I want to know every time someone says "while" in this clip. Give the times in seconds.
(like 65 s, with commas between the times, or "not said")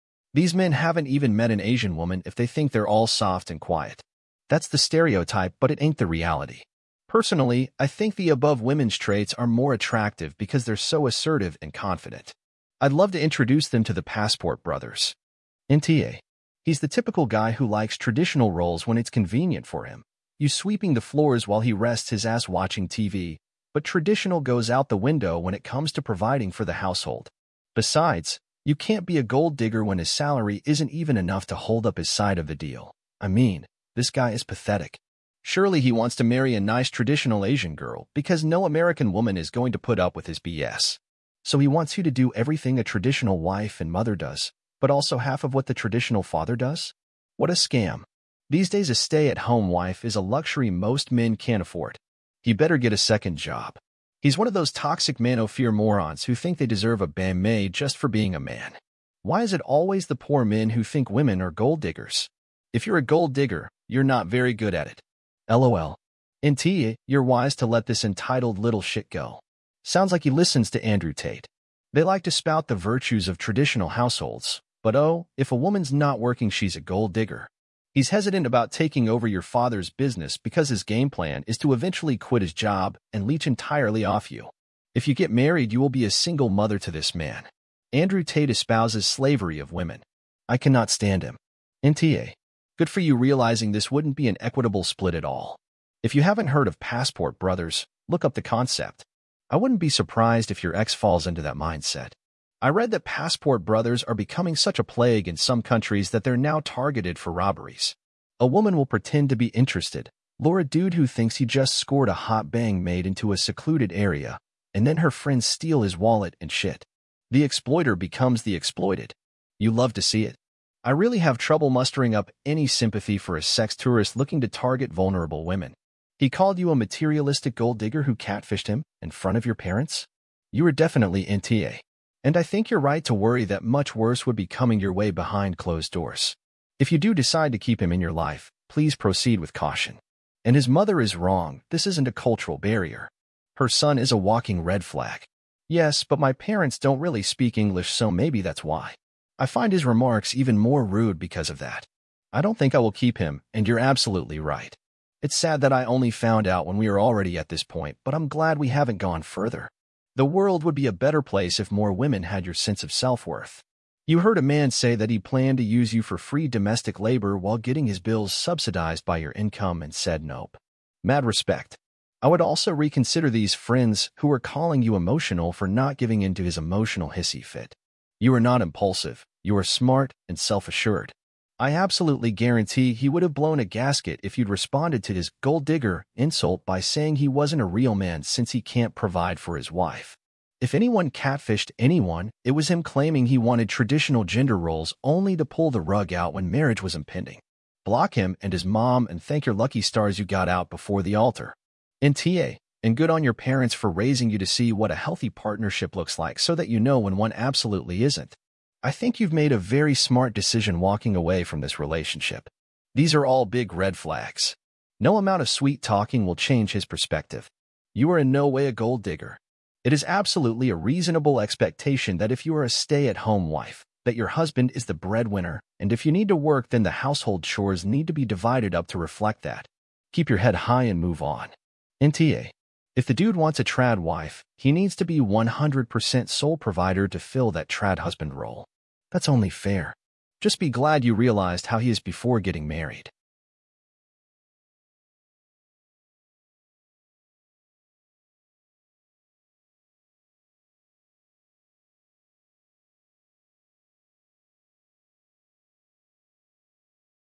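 21 s, 167 s.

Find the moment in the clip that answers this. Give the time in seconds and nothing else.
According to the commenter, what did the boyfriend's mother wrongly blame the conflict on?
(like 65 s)
142 s.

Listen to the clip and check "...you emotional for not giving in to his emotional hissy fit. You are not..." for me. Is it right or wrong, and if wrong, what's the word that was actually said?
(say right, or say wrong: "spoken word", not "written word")
right.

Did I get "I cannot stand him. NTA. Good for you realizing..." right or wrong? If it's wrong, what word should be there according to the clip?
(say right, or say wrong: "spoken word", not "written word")
right.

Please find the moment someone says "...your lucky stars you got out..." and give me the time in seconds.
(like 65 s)
199 s.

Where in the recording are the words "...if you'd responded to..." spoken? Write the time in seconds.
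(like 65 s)
184 s.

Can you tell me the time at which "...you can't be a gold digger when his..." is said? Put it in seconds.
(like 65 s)
28 s.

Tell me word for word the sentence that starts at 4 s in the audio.
That's the stereotype, but it ain't the reality.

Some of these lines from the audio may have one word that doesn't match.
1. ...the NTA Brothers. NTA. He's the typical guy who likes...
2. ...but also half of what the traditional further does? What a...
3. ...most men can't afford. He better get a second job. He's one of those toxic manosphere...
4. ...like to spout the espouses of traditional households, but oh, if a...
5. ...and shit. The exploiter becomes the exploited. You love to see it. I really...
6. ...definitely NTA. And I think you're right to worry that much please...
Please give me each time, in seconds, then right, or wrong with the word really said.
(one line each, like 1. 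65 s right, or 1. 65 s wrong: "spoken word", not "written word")
1. 13 s wrong: "Passport", not "NTA"
2. 44 s wrong: "father", not "further"
3. 50 s right
4. 72 s wrong: "virtues", not "espouses"
5. 116 s right
6. 130 s wrong: "worse", not "please".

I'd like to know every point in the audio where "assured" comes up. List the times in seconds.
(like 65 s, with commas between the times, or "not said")
180 s.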